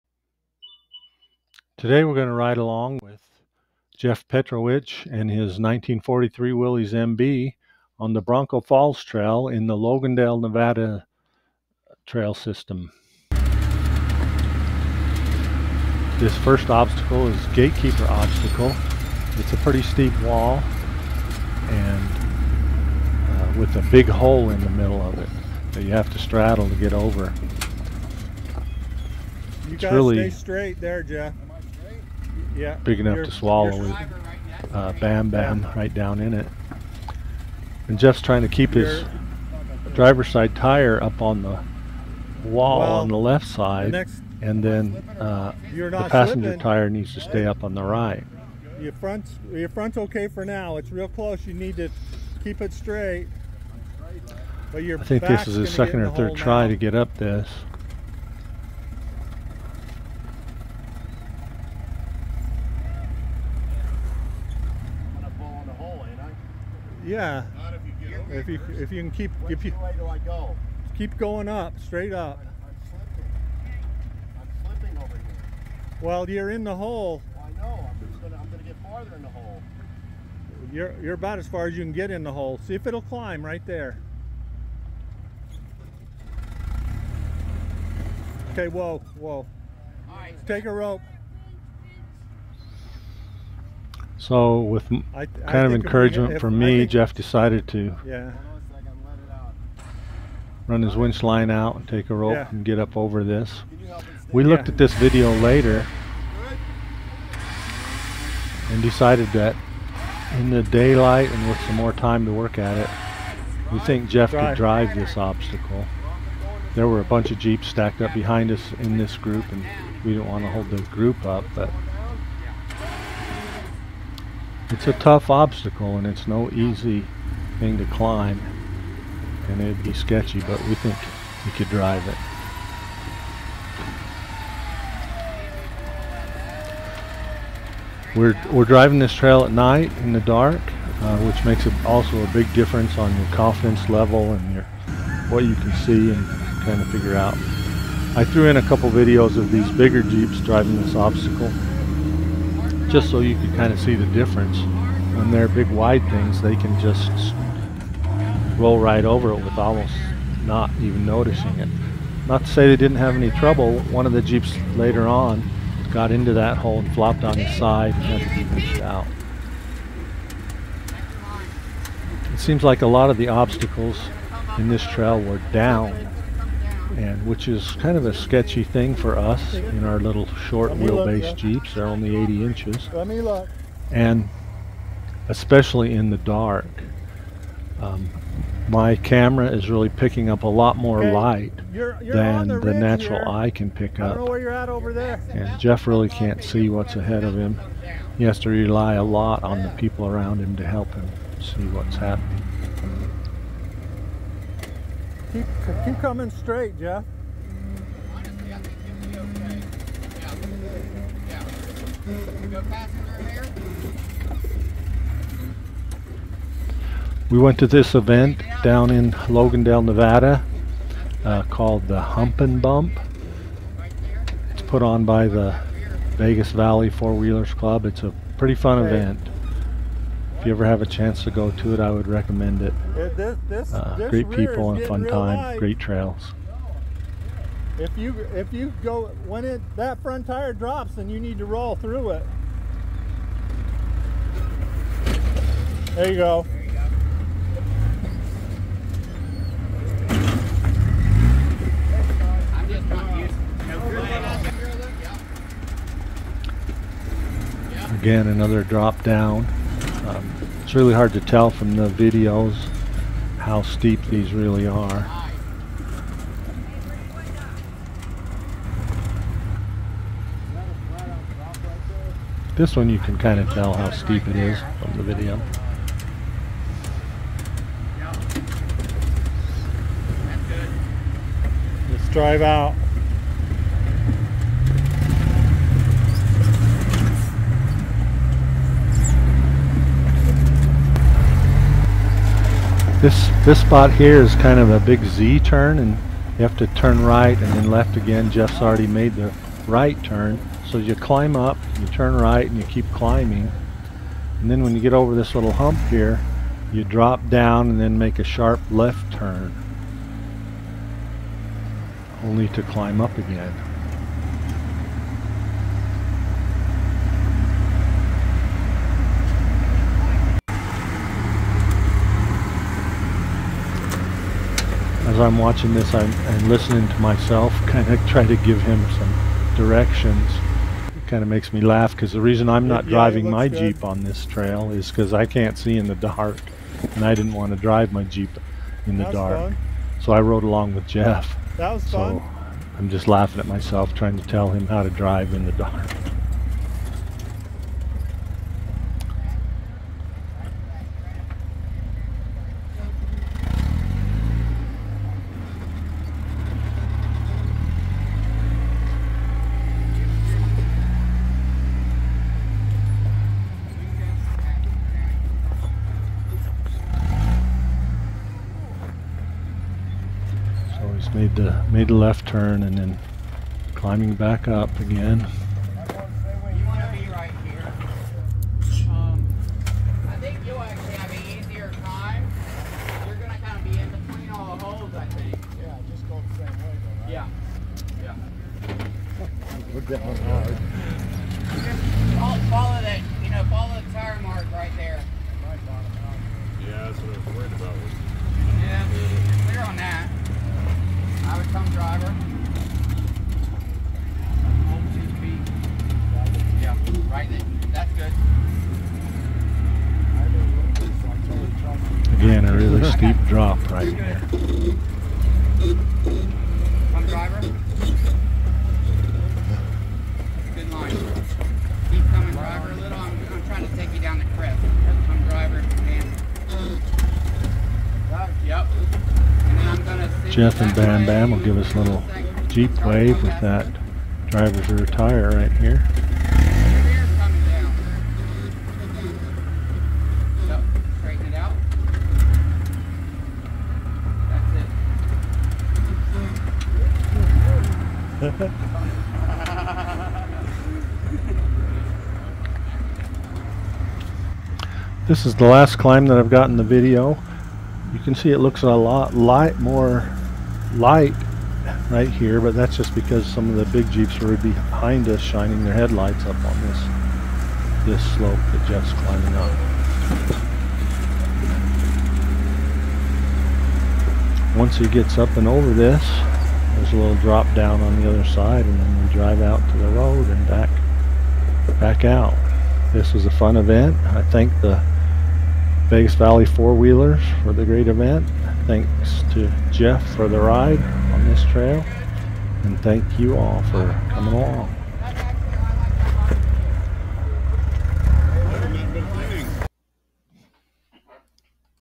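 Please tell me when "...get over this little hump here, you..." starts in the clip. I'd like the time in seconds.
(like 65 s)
304 s.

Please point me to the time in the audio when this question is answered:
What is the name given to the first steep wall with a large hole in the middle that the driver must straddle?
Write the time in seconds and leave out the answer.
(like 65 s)
17 s.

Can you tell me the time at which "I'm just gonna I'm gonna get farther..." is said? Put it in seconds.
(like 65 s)
77 s.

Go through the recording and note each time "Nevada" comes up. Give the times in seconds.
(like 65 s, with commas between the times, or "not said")
10 s, 219 s.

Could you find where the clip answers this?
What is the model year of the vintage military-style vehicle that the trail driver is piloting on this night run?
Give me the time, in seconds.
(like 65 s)
5 s.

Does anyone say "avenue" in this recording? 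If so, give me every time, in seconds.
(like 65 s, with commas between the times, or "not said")
not said.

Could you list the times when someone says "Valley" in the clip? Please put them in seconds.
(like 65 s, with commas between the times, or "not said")
226 s, 486 s.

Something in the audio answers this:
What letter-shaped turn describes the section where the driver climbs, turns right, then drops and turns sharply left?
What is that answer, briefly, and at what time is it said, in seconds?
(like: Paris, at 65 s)
Z, at 295 s.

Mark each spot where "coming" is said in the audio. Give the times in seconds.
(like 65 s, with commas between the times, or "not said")
205 s, 422 s, 494 s.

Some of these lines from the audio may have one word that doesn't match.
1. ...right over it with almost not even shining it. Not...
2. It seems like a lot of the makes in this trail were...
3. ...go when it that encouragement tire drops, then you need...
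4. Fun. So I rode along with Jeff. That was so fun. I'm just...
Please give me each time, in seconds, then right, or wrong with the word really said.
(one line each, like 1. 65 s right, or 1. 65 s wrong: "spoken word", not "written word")
1. 158 s wrong: "noticing", not "shining"
2. 172 s wrong: "obstacles", not "makes"
3. 238 s wrong: "front", not "encouragement"
4. 339 s right.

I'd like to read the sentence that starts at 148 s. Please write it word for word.
I threw in a couple videos of these bigger Jeeps driving this obstacle just so you could kind of see the difference.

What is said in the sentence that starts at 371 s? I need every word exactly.
made the made the left turn and then climbing back up again.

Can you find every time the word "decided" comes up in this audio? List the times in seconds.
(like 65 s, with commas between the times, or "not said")
97 s, 108 s.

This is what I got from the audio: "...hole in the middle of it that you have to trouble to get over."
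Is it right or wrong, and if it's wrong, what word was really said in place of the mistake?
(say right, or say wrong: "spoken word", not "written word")
wrong: "straddle", not "trouble".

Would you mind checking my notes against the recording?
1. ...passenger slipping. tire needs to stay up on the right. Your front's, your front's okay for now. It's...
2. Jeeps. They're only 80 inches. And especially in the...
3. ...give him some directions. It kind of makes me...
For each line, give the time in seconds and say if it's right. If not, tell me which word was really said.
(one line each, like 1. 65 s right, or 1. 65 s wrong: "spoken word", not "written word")
1. 46 s right
2. 181 s right
3. 328 s right.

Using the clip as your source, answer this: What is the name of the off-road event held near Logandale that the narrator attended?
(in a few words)
Hump and Bump.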